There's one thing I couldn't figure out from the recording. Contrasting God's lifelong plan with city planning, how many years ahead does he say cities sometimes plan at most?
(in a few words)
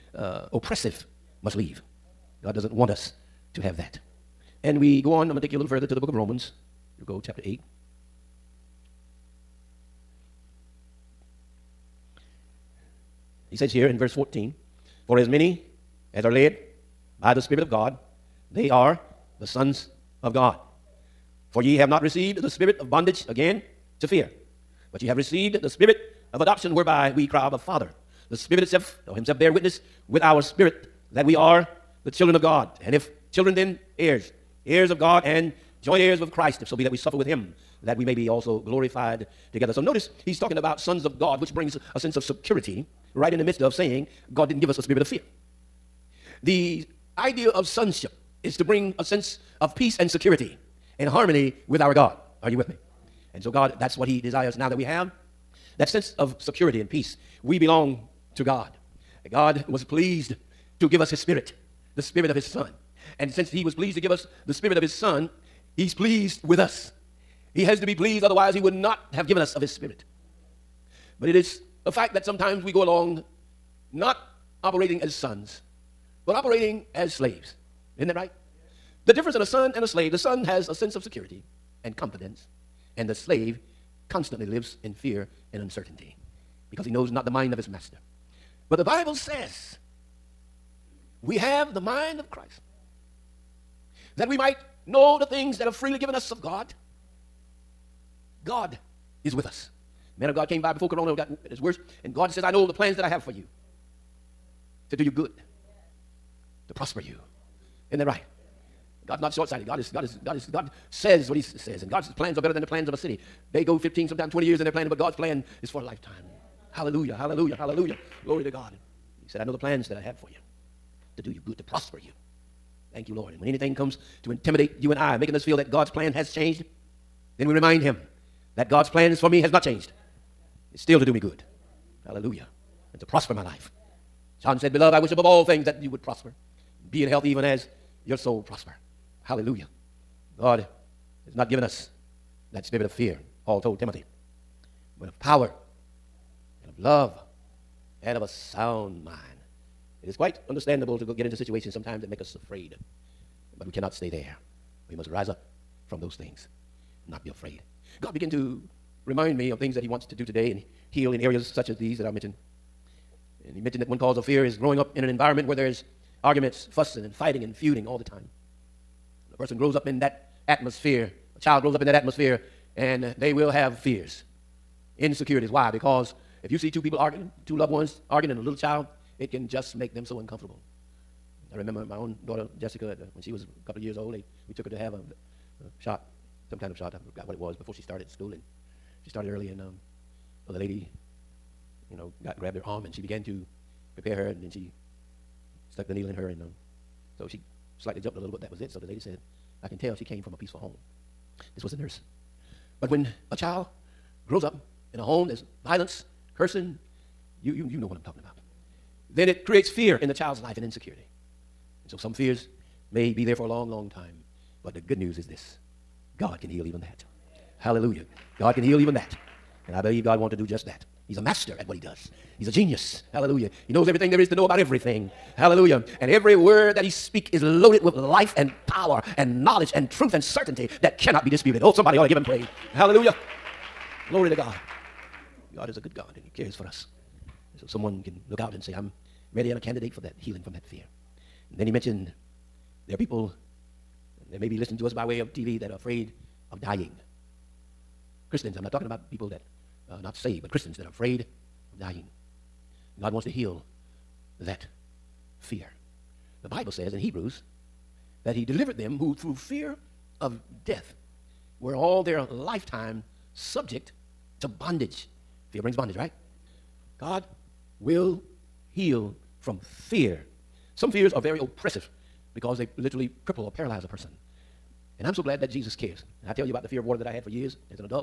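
20.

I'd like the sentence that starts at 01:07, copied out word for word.
He has to be pleased, otherwise, He would not have given us of His Spirit.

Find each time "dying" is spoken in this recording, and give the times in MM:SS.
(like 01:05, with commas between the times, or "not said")
04:06, 04:11.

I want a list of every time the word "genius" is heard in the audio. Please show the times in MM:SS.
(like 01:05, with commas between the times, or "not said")
03:42.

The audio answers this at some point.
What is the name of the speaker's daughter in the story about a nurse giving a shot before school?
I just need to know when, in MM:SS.
03:02.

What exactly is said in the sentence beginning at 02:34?
We must rise up from those things, not be afraid.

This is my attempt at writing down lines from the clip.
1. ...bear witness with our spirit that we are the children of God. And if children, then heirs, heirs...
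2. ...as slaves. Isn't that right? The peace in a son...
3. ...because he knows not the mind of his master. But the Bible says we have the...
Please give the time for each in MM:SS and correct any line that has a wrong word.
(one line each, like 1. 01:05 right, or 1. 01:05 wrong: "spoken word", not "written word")
1. 00:29 right
2. 01:16 wrong: "difference", not "peace"
3. 01:26 right.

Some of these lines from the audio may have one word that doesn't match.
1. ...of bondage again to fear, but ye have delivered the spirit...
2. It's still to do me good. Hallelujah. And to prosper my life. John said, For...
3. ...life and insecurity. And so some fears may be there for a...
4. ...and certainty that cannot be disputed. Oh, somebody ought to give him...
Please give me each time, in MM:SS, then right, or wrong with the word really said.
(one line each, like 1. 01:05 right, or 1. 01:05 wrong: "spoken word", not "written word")
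1. 00:22 wrong: "received", not "delivered"
2. 02:10 wrong: "Beloved", not "For"
3. 03:30 right
4. 03:50 right.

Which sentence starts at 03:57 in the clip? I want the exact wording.
So someone can look out and say, I'm ready and a candidate for that healing from that fear.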